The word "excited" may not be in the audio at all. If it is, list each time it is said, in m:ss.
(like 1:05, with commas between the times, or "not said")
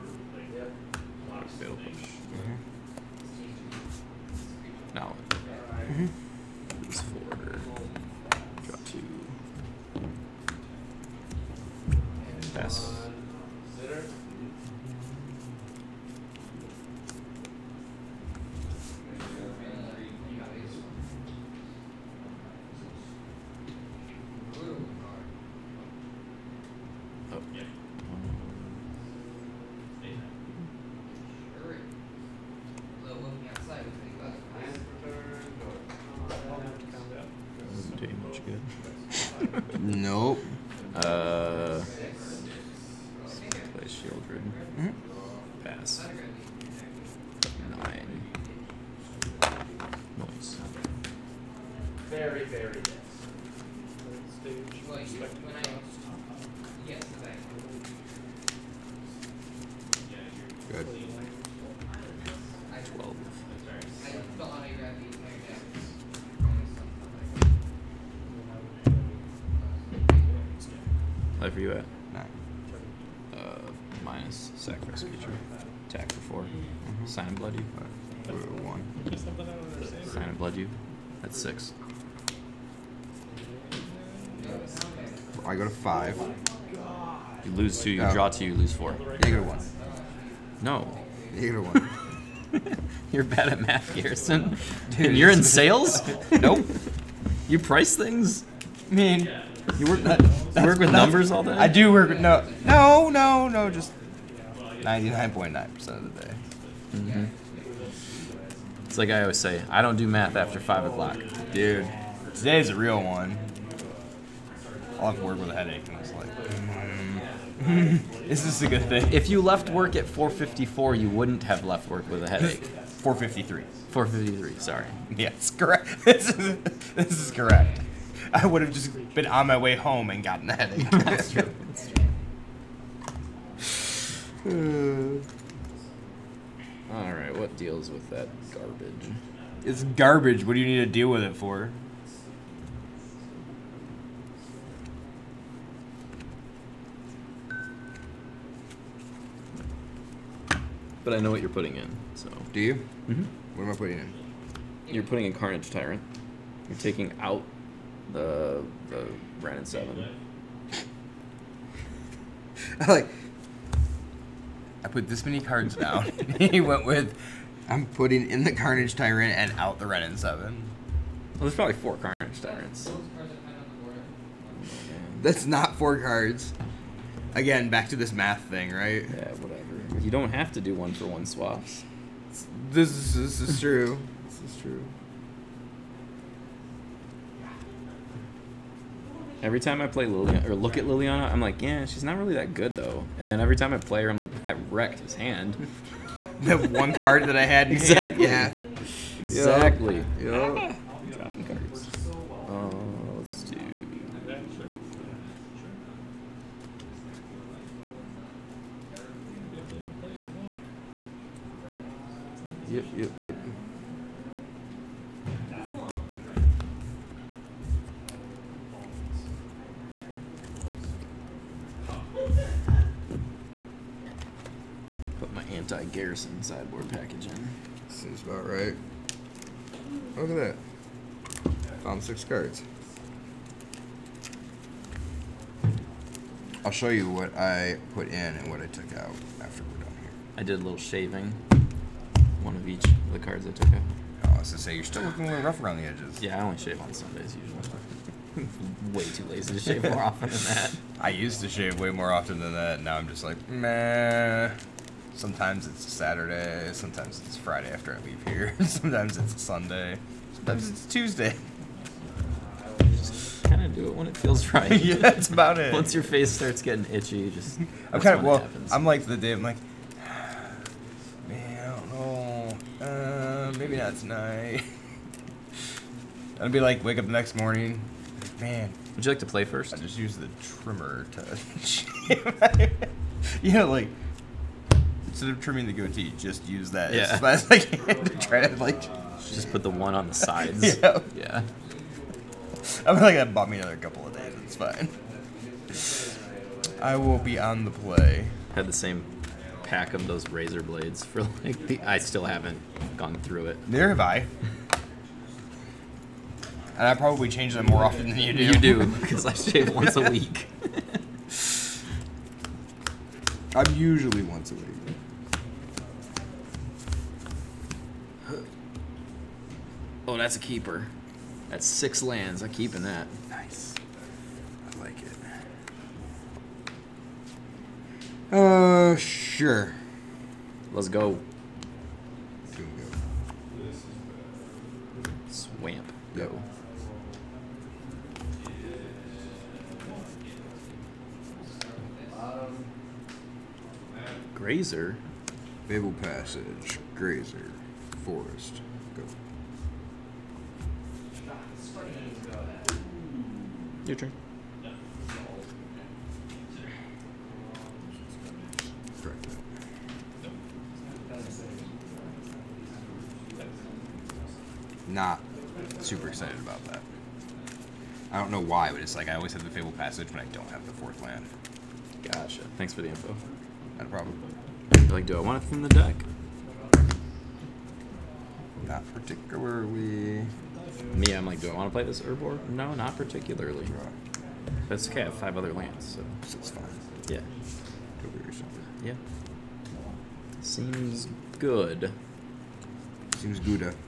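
6:06.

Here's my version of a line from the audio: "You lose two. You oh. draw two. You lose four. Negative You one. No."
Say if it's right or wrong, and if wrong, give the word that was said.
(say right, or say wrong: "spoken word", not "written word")
right.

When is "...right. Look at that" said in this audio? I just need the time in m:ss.
3:48.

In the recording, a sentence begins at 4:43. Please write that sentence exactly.
you know, like instead of trimming the goatee, just use that yeah.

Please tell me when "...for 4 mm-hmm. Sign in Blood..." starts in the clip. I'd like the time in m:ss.
1:16.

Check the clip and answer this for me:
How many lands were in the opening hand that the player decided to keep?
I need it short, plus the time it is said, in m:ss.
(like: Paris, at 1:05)
6, at 5:21.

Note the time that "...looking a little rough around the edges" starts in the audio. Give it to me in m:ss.
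4:05.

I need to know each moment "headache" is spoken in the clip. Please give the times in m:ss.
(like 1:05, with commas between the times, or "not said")
1:55, 2:02, 2:10.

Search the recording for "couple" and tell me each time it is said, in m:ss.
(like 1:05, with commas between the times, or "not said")
4:53.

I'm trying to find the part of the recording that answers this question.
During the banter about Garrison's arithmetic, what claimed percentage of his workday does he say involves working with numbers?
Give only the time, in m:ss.
1:44.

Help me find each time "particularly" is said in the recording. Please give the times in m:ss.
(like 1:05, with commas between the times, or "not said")
6:18, 6:22.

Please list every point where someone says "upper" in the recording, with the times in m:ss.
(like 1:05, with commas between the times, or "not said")
not said.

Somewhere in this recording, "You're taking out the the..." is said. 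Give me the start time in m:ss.
2:36.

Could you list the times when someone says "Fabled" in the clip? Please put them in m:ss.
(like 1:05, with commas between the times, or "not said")
5:45, 6:09.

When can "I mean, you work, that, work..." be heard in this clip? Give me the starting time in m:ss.
1:38.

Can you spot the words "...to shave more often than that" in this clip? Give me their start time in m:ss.
4:09.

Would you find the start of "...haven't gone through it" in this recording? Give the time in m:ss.
5:02.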